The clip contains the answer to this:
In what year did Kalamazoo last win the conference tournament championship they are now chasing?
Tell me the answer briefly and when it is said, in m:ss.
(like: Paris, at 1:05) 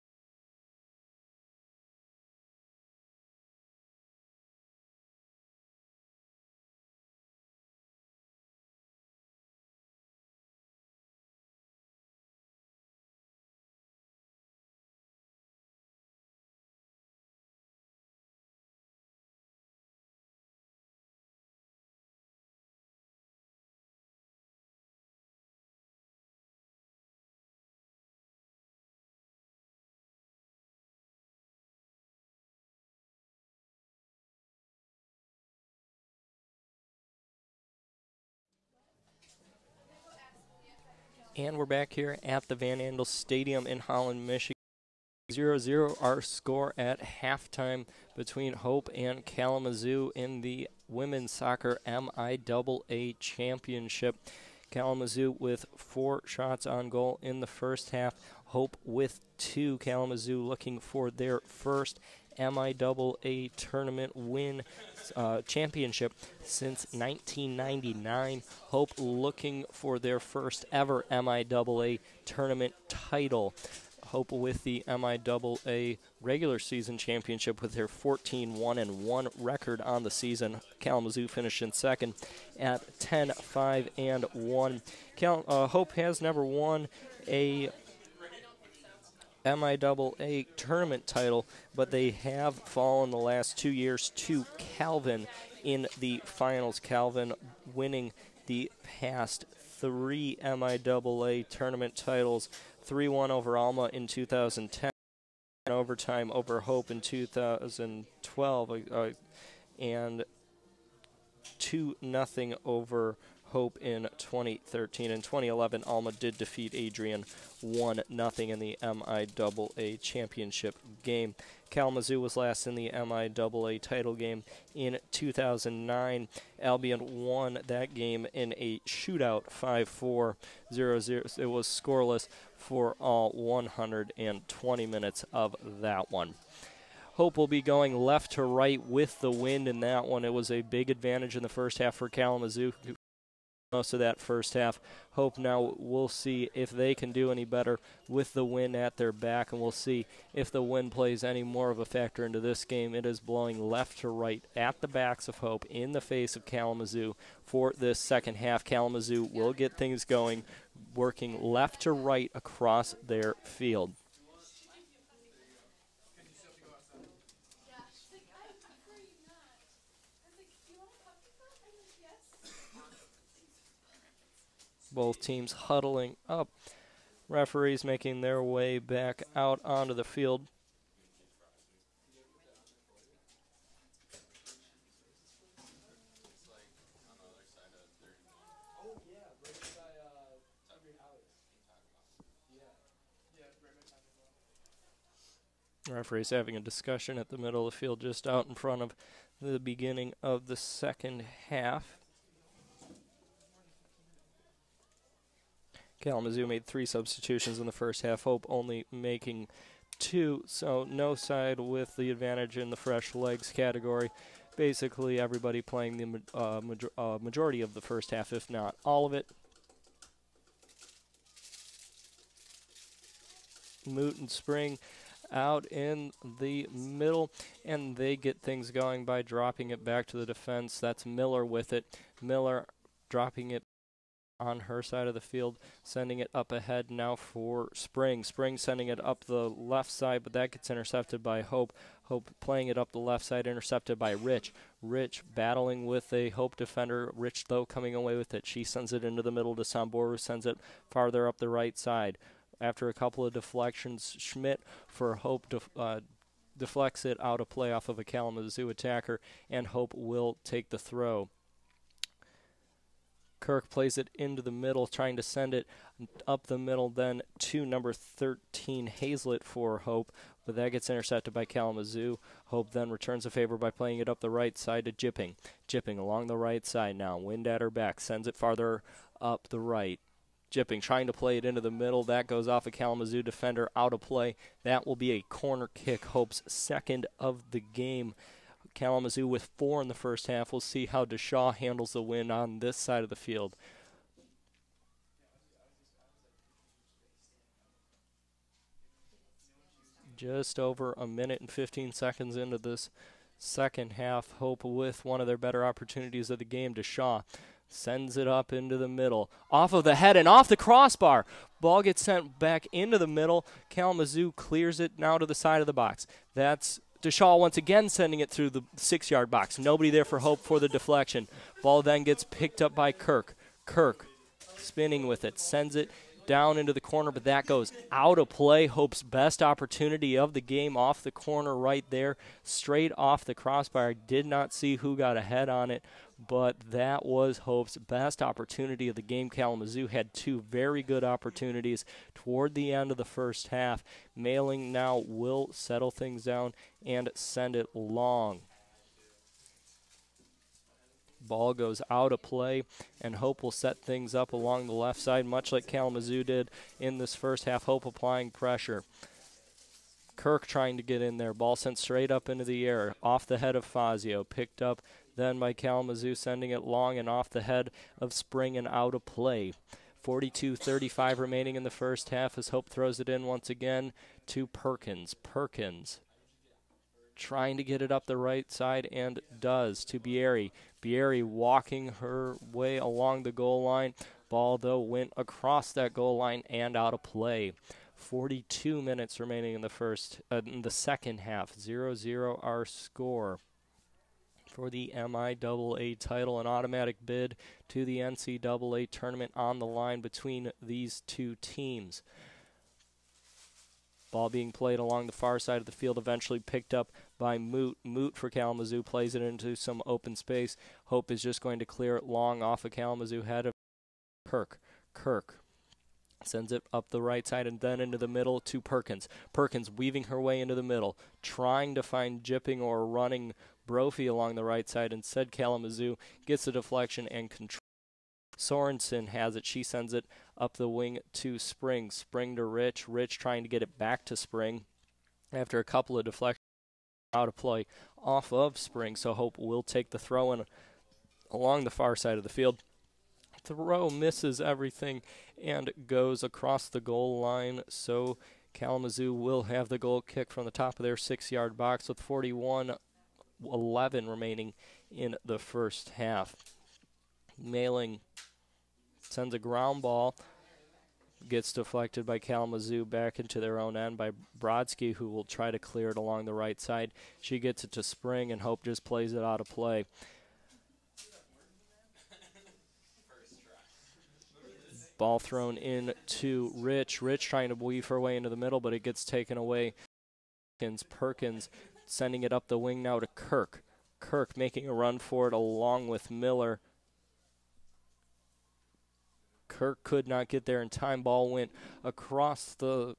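1999, at 1:06.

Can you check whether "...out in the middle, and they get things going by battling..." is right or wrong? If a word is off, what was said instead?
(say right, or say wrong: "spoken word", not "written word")
wrong: "dropping", not "battling".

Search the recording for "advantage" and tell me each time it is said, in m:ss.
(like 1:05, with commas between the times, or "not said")
2:20, 3:32.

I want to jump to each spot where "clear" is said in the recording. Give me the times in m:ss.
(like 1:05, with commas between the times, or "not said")
5:14, 6:51, 7:45.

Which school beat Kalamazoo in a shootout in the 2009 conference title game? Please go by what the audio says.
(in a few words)
Albion.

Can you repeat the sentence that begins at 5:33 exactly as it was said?
Did not see who got ahead on it, but that was Hope's best opportunity of the game.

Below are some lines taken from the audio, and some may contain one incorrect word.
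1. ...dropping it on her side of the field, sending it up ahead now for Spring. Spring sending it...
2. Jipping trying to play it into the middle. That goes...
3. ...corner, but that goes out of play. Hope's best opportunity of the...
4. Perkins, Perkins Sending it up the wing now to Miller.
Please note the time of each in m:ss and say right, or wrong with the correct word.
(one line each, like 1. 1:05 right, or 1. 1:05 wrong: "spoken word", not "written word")
1. 3:53 right
2. 4:40 right
3. 5:26 right
4. 8:00 wrong: "Kirk", not "Miller".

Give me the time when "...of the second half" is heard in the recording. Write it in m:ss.
3:20.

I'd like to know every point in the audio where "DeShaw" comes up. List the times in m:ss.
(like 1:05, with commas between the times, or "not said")
4:51, 5:06, 5:17.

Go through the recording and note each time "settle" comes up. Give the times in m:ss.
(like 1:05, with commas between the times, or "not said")
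5:45.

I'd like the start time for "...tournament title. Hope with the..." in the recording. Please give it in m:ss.
1:12.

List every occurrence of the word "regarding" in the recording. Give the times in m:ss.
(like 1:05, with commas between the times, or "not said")
not said.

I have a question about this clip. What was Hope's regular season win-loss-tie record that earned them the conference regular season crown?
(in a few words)
14-1-1.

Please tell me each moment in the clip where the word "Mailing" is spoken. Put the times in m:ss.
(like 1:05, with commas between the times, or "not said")
5:44, 7:37.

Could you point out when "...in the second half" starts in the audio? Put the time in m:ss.
6:30.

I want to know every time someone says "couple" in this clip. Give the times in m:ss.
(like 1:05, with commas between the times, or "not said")
4:12, 7:15.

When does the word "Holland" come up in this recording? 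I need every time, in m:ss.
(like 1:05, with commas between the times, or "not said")
0:43.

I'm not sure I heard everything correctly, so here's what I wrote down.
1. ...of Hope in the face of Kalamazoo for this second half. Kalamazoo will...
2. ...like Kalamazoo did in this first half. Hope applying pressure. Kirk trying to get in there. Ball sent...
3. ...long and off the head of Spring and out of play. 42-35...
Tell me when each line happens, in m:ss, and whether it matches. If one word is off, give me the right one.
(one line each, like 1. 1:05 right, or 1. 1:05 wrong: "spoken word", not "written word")
1. 2:35 right
2. 5:55 right
3. 6:06 right.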